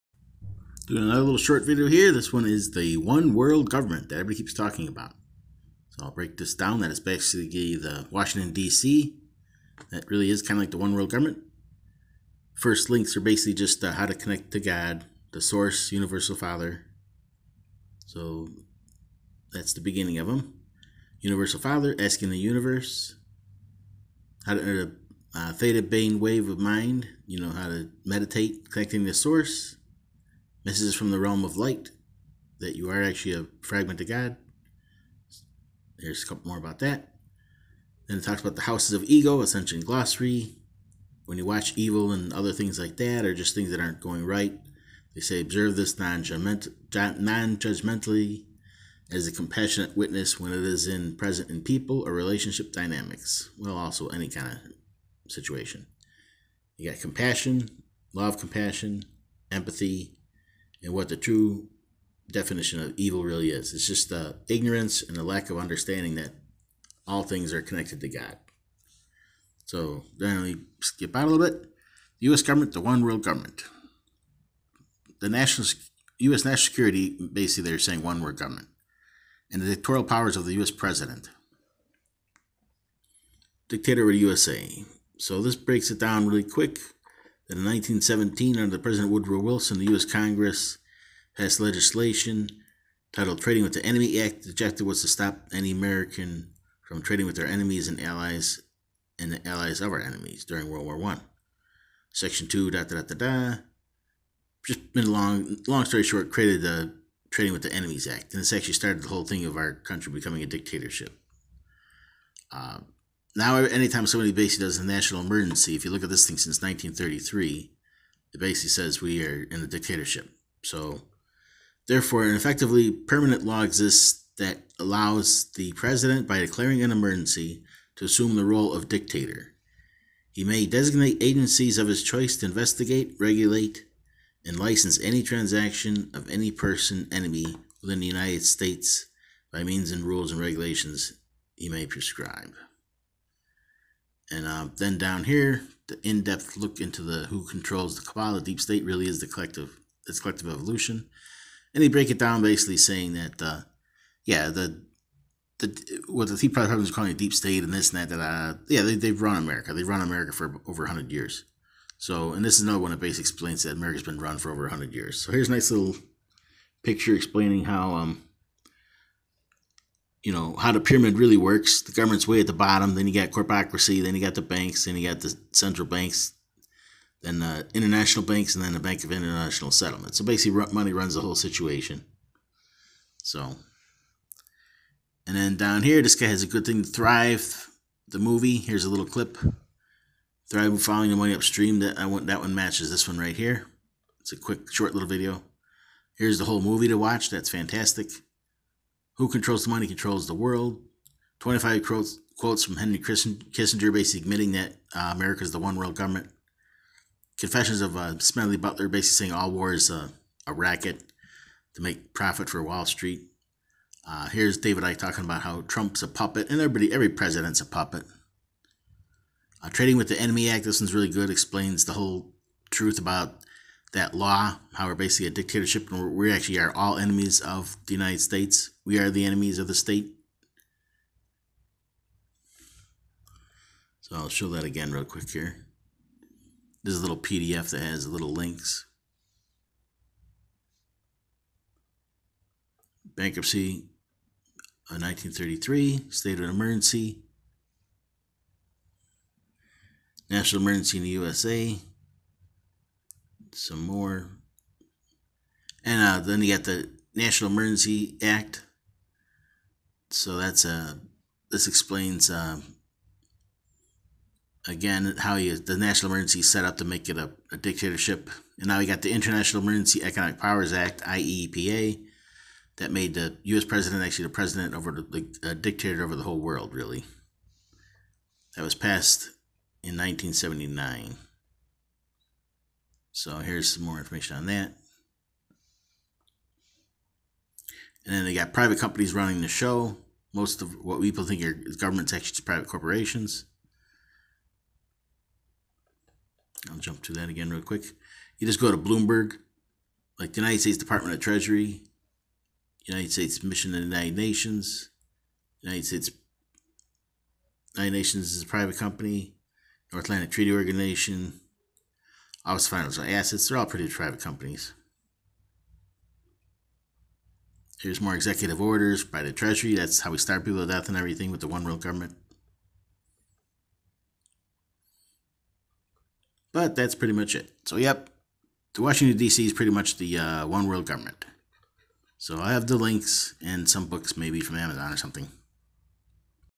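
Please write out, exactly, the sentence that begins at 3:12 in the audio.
That one matches this one right here.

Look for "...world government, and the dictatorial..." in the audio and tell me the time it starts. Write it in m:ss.
1:18.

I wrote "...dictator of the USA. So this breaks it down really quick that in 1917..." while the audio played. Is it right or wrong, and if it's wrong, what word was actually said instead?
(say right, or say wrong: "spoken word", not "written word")
right.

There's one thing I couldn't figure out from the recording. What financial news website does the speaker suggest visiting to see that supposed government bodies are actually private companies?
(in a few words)
Bloomberg.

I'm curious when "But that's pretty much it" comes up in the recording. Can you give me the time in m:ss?
5:26.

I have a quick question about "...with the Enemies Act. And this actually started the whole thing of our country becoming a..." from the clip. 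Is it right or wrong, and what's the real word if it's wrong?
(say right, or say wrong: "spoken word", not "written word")
right.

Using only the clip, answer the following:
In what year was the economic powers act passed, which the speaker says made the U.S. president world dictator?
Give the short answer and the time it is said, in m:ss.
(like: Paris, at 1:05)
1979, at 4:39.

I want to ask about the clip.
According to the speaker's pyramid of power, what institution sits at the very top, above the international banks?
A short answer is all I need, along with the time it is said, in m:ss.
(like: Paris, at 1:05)
Bank of International Settlement, at 2:58.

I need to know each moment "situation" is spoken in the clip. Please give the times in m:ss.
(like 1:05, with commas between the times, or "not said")
0:55, 3:01.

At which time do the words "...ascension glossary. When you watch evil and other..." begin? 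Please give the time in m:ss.
0:39.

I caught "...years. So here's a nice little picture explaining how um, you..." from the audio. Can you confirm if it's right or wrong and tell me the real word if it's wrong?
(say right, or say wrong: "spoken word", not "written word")
right.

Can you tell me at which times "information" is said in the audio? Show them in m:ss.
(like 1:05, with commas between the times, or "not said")
4:43.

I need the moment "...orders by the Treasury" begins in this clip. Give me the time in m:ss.
5:18.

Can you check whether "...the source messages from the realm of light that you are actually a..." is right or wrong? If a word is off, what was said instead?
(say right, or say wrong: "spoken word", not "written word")
right.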